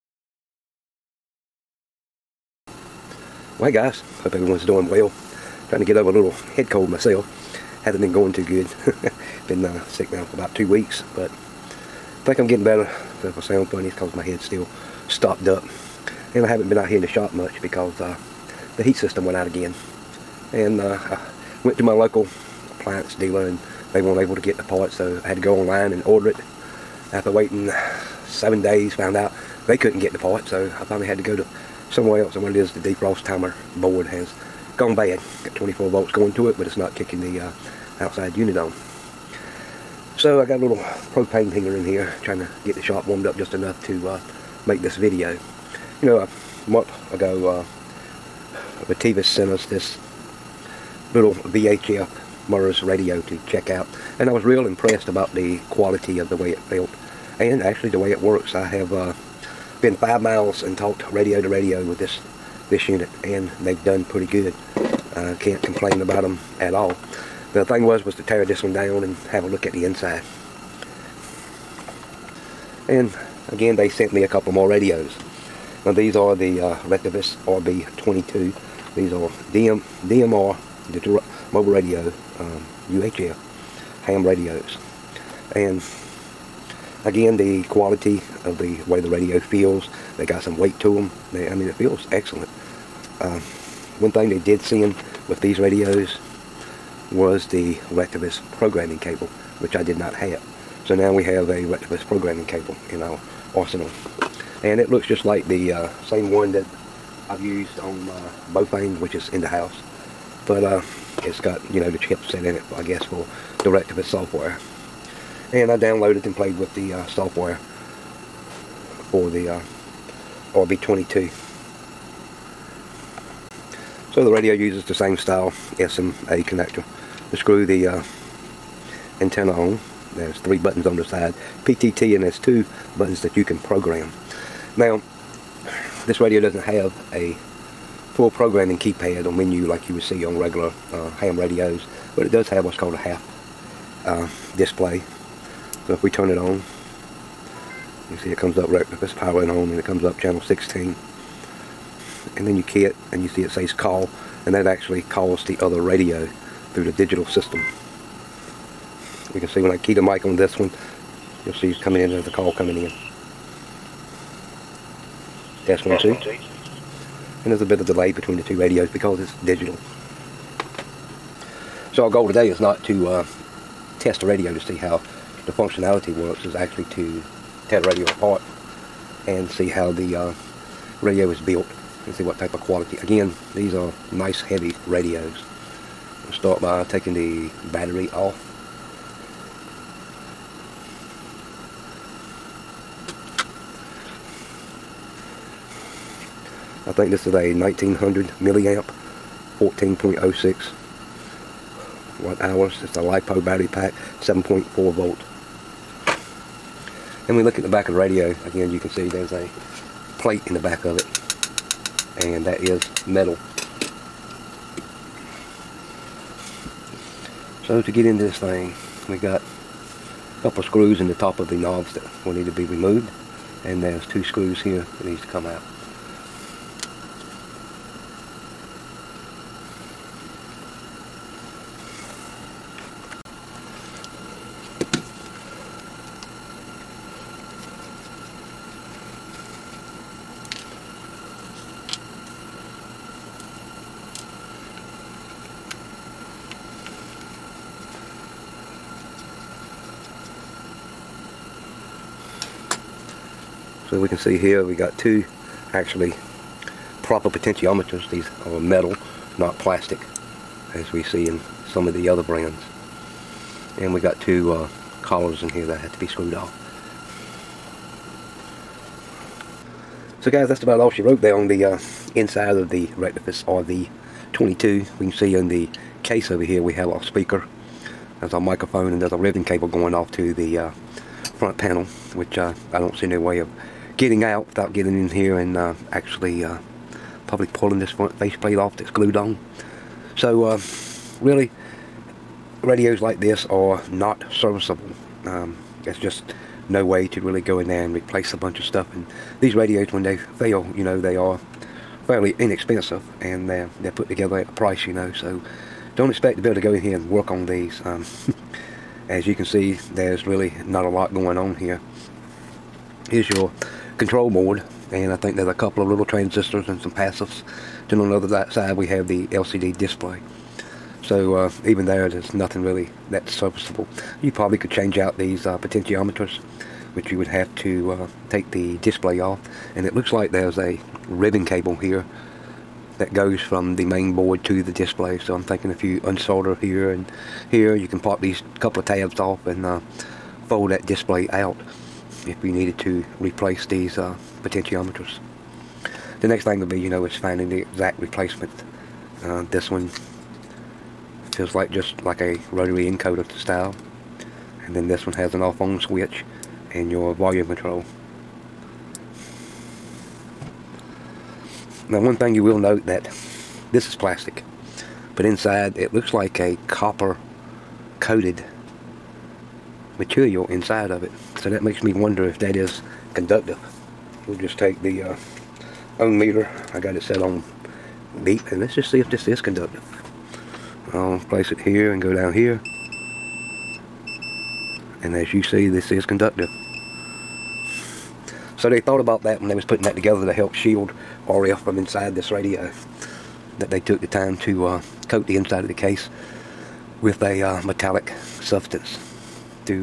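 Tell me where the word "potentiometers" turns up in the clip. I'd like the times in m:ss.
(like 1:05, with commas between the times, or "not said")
4:17, 5:25, 5:44.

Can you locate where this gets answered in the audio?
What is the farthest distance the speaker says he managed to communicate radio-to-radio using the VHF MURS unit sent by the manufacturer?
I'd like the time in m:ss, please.
0:59.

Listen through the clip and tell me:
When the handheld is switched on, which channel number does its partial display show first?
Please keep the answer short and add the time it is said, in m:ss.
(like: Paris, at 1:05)
16, at 2:30.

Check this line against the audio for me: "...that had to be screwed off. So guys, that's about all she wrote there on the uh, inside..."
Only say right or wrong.
right.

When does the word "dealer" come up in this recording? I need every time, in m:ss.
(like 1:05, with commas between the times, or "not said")
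0:23.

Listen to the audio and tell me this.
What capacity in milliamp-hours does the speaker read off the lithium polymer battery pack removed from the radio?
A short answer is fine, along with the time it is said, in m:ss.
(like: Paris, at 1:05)
1900, at 3:17.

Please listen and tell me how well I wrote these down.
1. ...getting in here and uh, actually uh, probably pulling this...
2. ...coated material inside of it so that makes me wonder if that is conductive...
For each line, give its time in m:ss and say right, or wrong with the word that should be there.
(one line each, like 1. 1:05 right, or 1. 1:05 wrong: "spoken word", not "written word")
1. 4:44 right
2. 6:07 right.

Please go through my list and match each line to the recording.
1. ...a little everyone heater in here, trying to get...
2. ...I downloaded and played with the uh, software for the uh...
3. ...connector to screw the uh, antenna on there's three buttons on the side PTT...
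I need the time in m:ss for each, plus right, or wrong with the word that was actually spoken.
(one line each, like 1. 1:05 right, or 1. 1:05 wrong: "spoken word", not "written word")
1. 0:40 wrong: "propane", not "everyone"
2. 1:55 right
3. 2:06 right.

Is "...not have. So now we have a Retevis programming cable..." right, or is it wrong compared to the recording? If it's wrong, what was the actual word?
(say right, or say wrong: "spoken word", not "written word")
right.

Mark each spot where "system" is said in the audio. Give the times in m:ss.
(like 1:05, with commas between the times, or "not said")
0:18, 2:37.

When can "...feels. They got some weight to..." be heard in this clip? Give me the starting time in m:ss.
1:29.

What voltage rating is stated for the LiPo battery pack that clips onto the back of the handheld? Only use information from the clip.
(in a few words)
7.4 volts.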